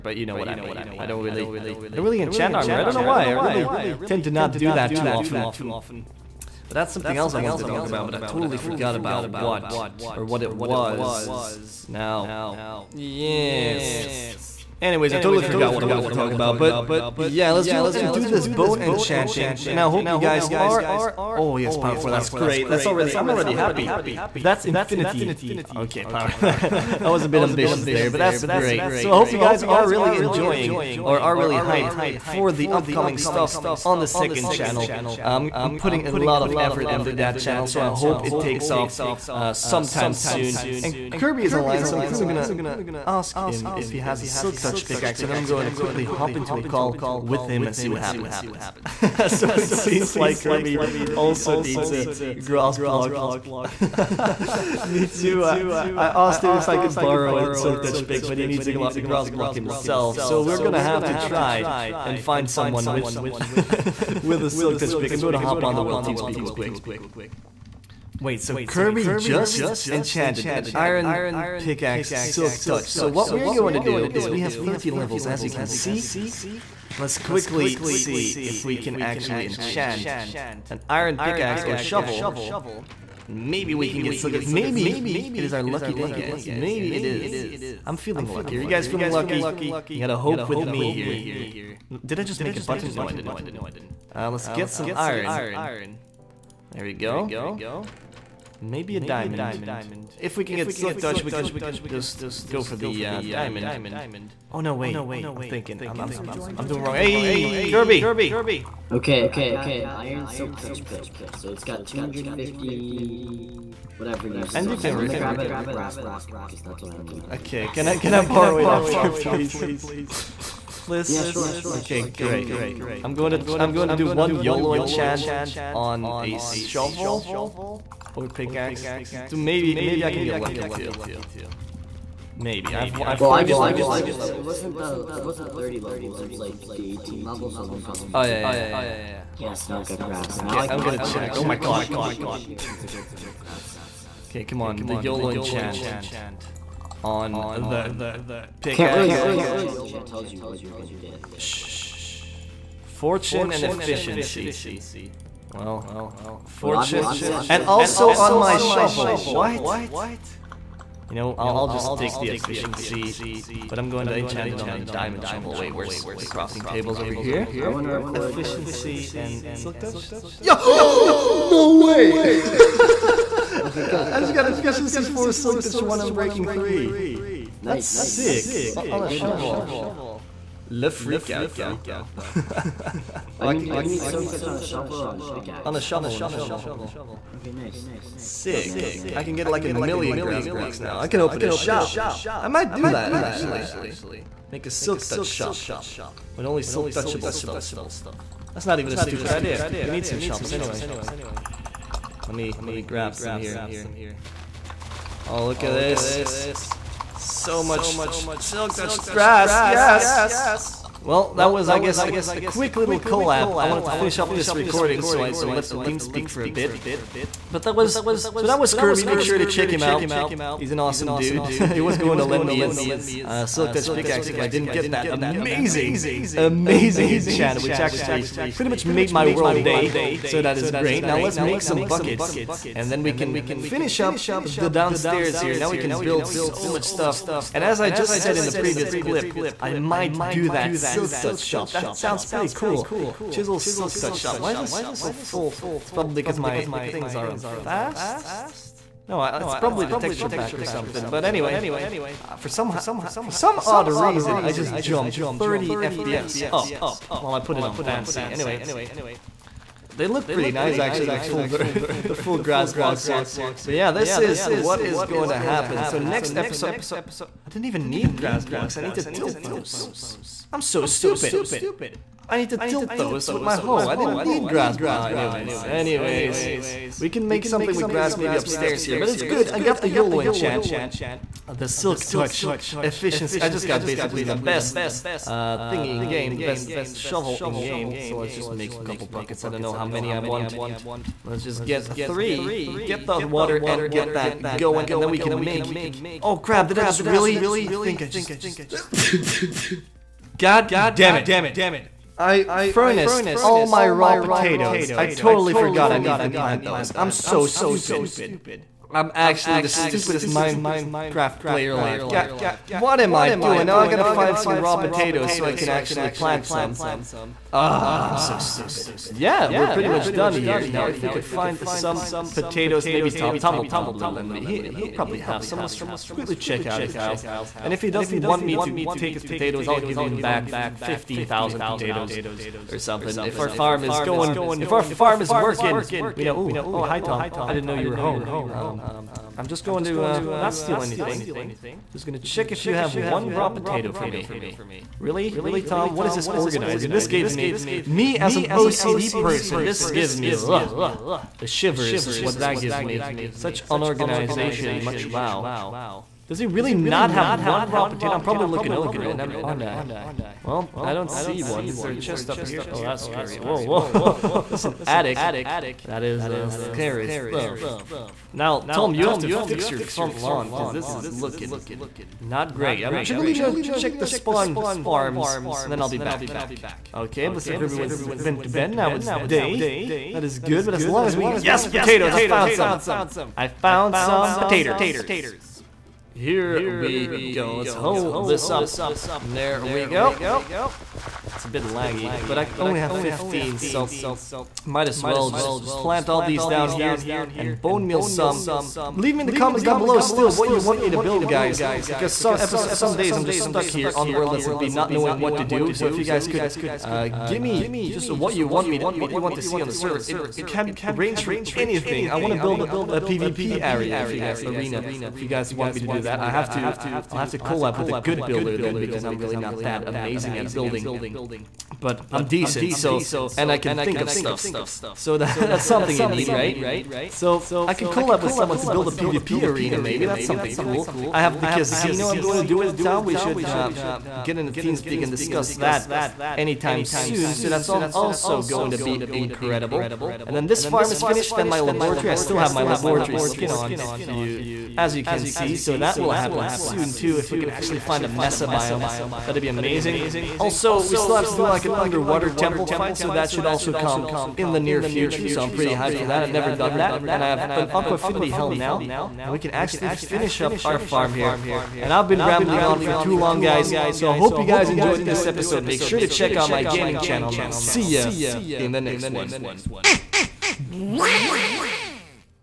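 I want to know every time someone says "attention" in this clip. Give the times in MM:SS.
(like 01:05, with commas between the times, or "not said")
not said.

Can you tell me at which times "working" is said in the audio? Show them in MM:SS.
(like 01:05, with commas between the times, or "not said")
05:35.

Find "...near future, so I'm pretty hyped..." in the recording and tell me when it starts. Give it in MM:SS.
07:34.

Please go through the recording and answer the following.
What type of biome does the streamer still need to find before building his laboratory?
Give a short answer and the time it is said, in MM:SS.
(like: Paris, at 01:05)
Mesa, at 07:28.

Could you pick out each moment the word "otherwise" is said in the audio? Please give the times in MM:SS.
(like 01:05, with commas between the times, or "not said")
not said.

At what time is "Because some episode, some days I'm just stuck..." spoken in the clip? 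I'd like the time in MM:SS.
06:41.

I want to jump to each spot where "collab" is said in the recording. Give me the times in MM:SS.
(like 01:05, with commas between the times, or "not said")
03:32, 06:57, 07:07.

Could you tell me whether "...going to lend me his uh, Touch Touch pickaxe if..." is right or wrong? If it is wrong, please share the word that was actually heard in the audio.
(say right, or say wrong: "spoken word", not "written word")
wrong: "Silk", not "Touch".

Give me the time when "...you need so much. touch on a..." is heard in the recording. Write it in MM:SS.
03:03.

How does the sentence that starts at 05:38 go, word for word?
Um, I'm just going to uh, not steal anything.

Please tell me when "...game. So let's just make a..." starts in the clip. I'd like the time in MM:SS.
04:47.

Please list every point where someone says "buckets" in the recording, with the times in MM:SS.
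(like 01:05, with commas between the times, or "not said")
03:51, 04:49.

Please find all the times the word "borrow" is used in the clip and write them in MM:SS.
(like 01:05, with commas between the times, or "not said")
00:56, 01:58.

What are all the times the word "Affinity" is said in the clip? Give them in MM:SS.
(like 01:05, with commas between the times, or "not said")
07:37.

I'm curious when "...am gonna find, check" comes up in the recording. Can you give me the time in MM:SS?
02:20.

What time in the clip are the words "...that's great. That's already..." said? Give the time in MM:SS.
00:22.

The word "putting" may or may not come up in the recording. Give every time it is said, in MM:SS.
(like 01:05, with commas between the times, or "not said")
00:35.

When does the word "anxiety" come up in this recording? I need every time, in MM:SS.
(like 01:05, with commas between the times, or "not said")
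not said.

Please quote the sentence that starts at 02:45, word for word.
Wait, where's the crafting tables over here?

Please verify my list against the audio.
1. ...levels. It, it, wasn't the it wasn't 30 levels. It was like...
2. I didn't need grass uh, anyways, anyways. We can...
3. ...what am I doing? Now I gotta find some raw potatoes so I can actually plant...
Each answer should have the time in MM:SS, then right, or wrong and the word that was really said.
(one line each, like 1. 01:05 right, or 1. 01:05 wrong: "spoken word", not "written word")
1. 02:13 right
2. 04:33 right
3. 05:12 right.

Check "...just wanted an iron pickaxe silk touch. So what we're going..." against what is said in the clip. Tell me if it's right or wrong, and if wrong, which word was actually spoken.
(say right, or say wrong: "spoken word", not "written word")
wrong: "enchanted", not "wanted".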